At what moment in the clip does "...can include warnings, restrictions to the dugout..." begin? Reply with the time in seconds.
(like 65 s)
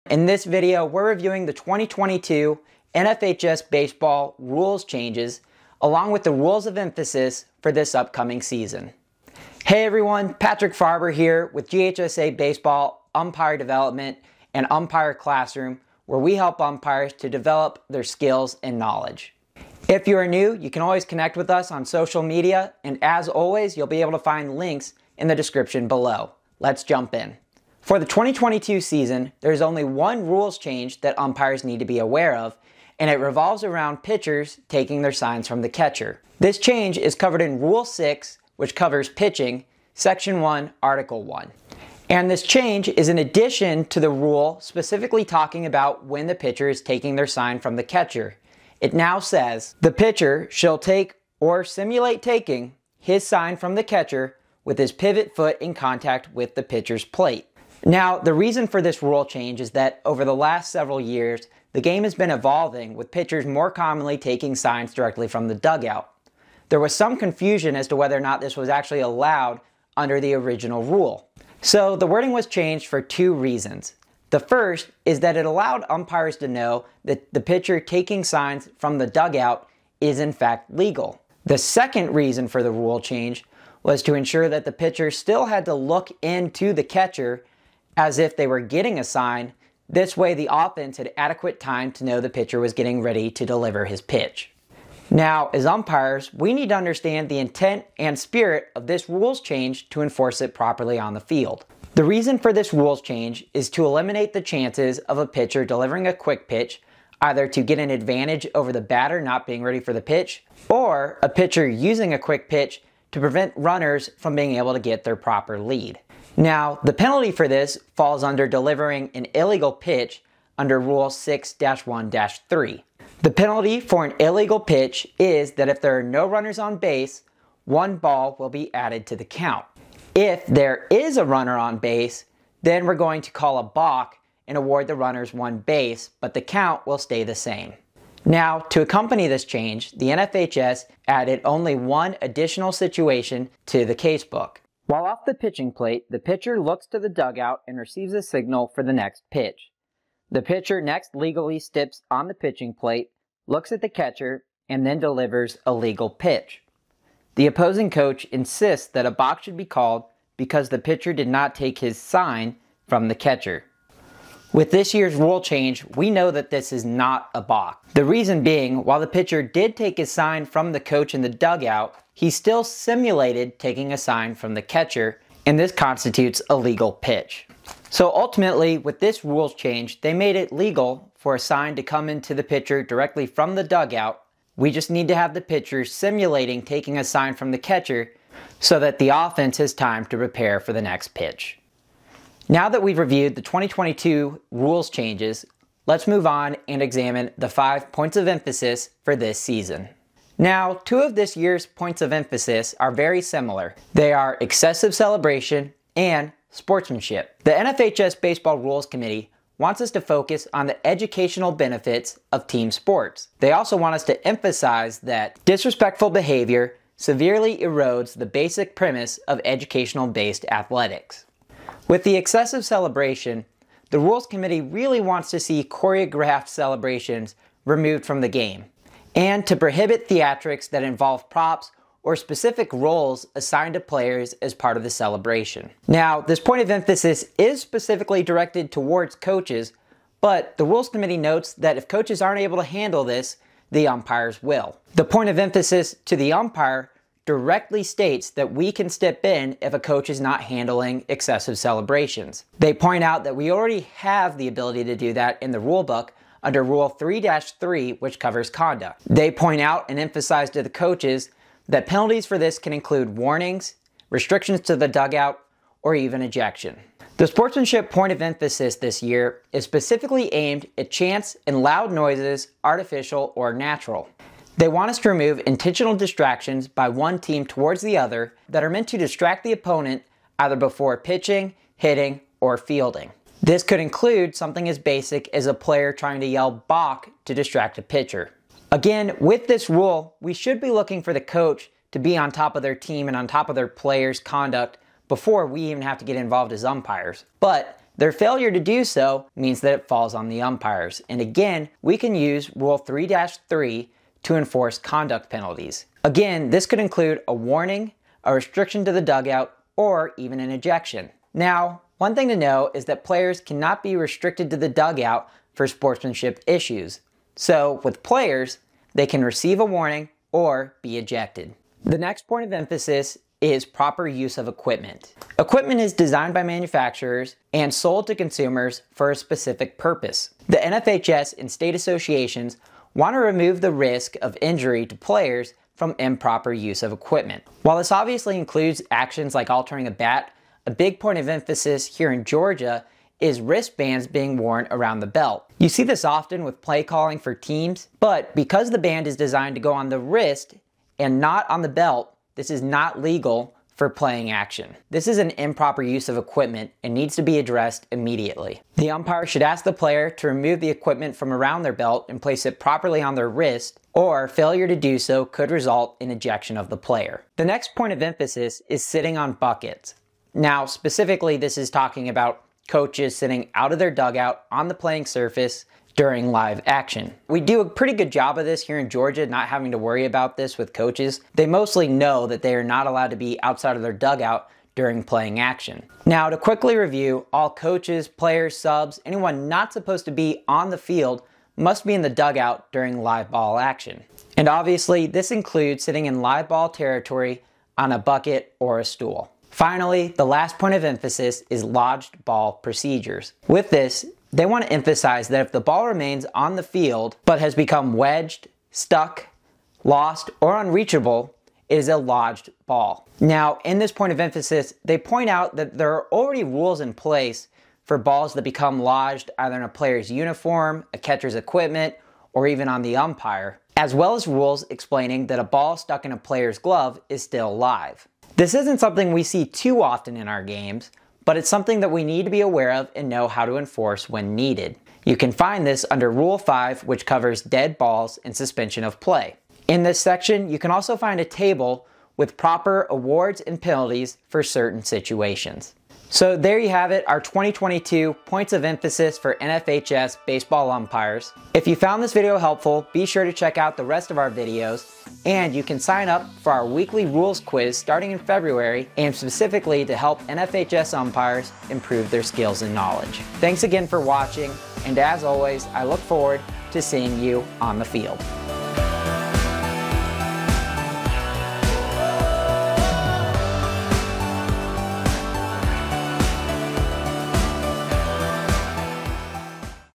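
262 s.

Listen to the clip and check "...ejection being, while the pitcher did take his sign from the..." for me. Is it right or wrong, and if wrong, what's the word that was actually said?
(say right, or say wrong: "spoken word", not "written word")
wrong: "reason", not "ejection".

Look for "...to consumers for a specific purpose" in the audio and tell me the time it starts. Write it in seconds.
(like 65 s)
328 s.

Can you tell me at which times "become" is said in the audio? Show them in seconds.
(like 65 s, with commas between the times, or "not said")
407 s, 418 s.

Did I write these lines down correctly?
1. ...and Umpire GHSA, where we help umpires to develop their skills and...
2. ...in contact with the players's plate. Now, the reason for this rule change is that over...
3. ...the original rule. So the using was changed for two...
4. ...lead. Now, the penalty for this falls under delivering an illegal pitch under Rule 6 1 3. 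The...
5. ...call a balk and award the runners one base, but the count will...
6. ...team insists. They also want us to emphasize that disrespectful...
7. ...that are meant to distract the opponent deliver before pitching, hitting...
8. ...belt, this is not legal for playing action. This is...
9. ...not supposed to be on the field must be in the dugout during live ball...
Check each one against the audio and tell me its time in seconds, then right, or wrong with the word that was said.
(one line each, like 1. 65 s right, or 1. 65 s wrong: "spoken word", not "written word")
1. 14 s wrong: "Classroom", not "GHSA"
2. 55 s wrong: "pitcher", not "players"
3. 70 s wrong: "wording", not "using"
4. 115 s right
5. 133 s right
6. 212 s wrong: "sports", not "insists"
7. 278 s wrong: "either", not "deliver"
8. 351 s right
9. 389 s right.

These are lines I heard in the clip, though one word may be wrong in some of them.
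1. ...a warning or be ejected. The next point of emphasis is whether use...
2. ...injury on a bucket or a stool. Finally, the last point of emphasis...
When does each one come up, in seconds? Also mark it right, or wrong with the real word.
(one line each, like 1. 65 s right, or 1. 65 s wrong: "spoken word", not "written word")
1. 319 s wrong: "proper", not "whether"
2. 396 s wrong: "territory", not "injury".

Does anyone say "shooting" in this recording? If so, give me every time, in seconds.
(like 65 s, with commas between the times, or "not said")
not said.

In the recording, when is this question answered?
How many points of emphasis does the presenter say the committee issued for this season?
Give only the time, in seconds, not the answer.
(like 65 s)
197 s.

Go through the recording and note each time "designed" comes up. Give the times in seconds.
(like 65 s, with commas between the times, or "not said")
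325 s, 349 s.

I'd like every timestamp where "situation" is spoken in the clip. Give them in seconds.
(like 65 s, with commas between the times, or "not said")
142 s, 444 s.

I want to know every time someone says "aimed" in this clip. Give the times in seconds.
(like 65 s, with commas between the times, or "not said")
270 s, 458 s.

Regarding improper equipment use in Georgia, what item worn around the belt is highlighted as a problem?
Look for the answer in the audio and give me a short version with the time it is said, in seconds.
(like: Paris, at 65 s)
Wristbands, at 343 s.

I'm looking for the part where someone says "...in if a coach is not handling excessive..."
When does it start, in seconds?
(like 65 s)
249 s.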